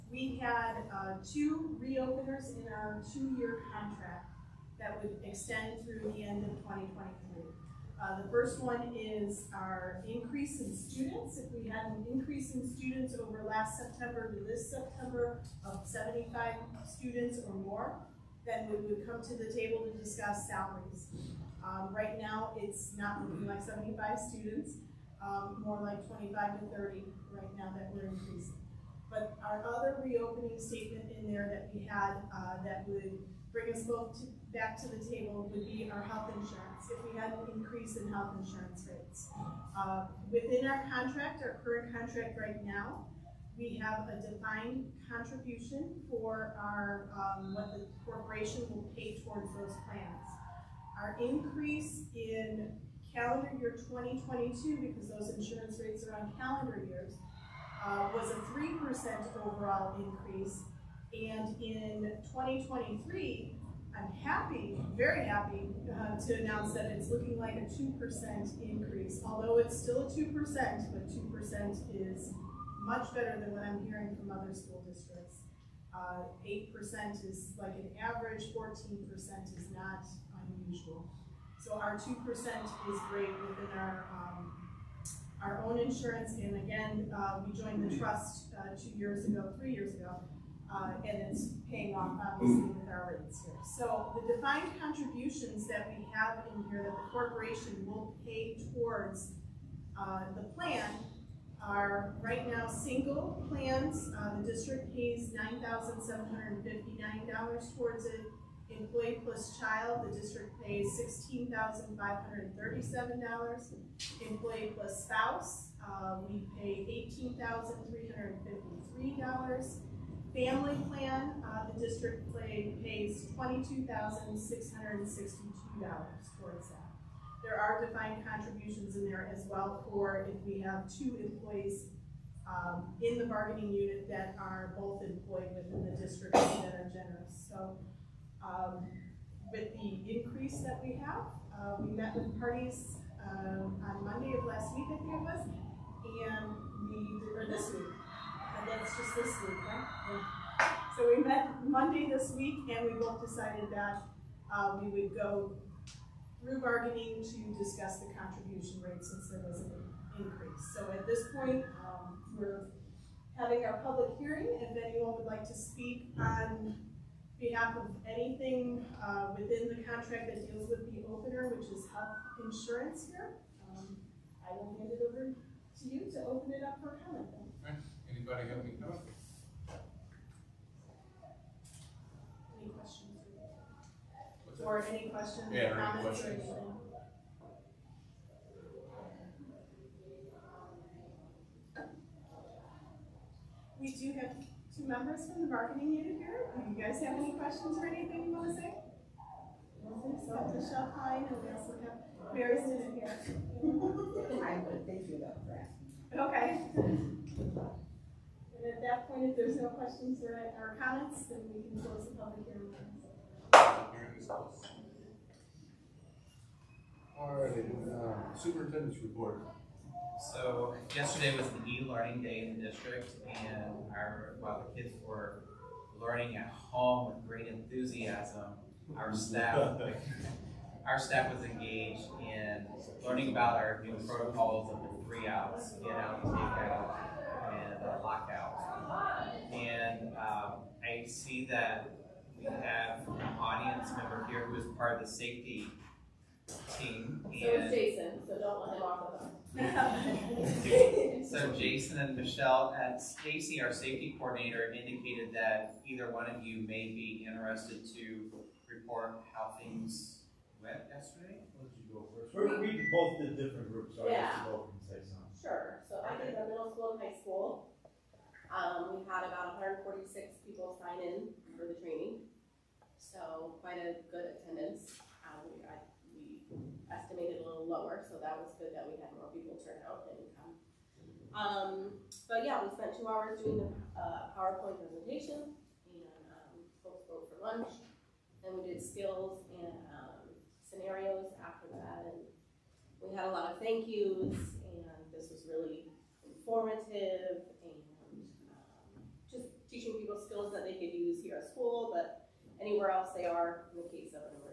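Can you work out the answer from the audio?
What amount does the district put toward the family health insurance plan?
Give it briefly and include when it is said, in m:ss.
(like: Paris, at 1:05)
$22,662, at 2:03.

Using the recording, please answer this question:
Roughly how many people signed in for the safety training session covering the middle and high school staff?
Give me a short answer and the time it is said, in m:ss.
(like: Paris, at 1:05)
146, at 4:29.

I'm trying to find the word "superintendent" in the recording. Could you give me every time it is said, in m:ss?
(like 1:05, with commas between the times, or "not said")
3:38.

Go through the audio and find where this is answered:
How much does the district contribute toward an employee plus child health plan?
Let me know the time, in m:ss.
1:51.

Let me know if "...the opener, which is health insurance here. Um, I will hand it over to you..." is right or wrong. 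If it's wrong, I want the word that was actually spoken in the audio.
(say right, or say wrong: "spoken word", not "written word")
right.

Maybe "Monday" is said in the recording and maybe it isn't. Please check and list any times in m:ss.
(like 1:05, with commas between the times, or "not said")
2:24, 2:31.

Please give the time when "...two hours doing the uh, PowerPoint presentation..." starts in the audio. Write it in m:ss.
4:42.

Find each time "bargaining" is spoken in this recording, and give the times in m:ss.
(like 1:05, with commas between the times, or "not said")
2:13, 2:36, 3:15.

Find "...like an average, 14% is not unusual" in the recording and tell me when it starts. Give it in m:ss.
1:17.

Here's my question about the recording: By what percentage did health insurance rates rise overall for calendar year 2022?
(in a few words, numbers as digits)
3%.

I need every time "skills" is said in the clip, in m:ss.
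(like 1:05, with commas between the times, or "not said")
4:48, 5:00.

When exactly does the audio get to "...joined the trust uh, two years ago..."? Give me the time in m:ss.
1:27.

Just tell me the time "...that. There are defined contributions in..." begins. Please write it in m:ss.
2:06.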